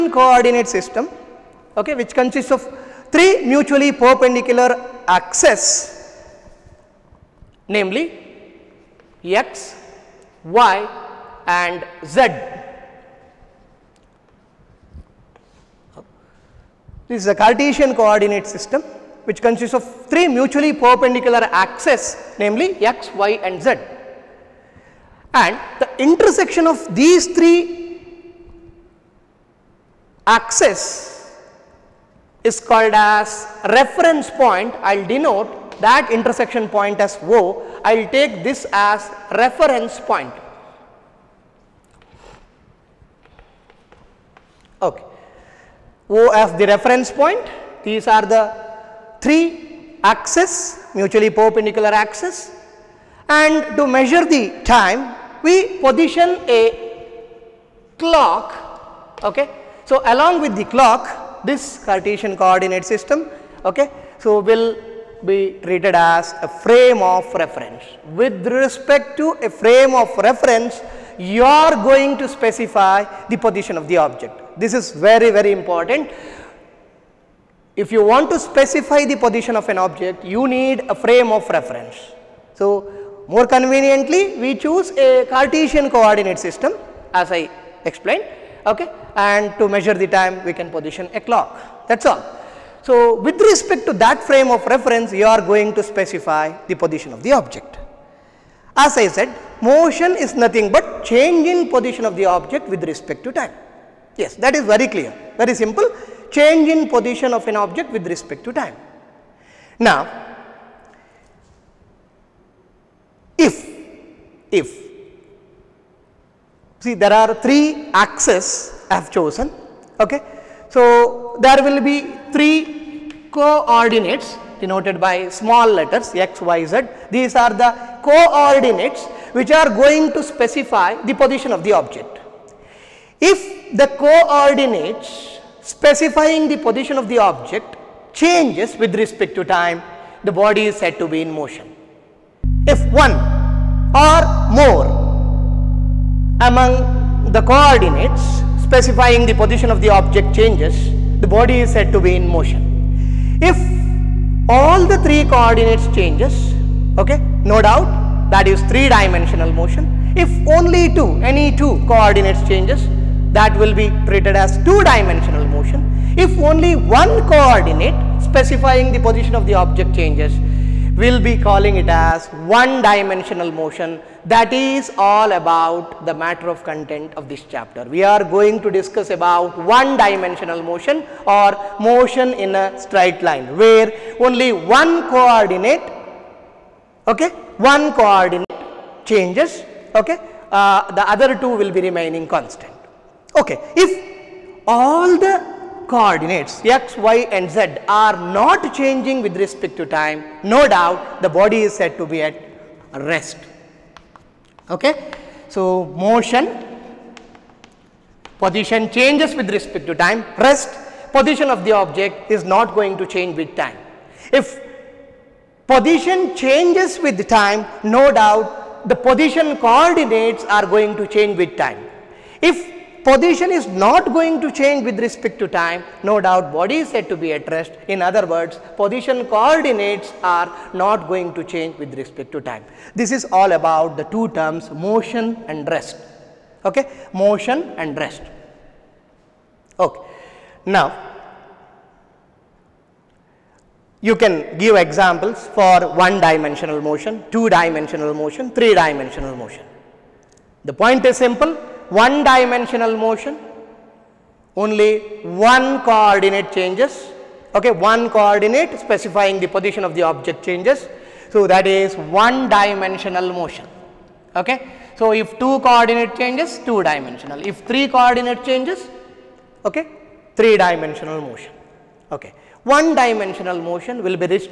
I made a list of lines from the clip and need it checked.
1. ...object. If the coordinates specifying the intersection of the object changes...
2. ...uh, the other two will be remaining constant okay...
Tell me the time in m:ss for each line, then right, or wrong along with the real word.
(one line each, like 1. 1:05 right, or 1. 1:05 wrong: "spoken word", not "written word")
1. 2:11 wrong: "position", not "intersection"
2. 3:10 right.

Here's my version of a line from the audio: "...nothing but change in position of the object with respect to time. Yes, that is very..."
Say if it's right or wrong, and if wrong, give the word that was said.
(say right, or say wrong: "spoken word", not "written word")
right.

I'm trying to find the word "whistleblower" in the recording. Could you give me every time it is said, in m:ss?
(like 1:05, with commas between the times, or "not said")
not said.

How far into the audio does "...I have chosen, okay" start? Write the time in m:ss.
1:58.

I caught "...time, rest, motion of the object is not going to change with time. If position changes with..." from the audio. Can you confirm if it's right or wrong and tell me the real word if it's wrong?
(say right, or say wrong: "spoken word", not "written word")
wrong: "position", not "motion".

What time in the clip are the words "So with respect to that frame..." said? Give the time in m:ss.
1:32.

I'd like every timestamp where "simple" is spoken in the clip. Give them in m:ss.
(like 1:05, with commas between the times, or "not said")
1:45, 4:11.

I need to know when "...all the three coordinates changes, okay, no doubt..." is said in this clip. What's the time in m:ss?
2:34.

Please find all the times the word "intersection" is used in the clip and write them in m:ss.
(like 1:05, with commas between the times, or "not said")
0:26, 0:36.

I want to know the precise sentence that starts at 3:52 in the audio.
This is all about the two terms motion and rest.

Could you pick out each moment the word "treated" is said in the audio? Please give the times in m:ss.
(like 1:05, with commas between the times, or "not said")
1:05, 2:44.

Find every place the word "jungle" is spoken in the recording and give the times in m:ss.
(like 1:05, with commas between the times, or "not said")
not said.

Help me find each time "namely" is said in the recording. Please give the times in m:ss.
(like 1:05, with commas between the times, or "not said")
0:07, 0:22.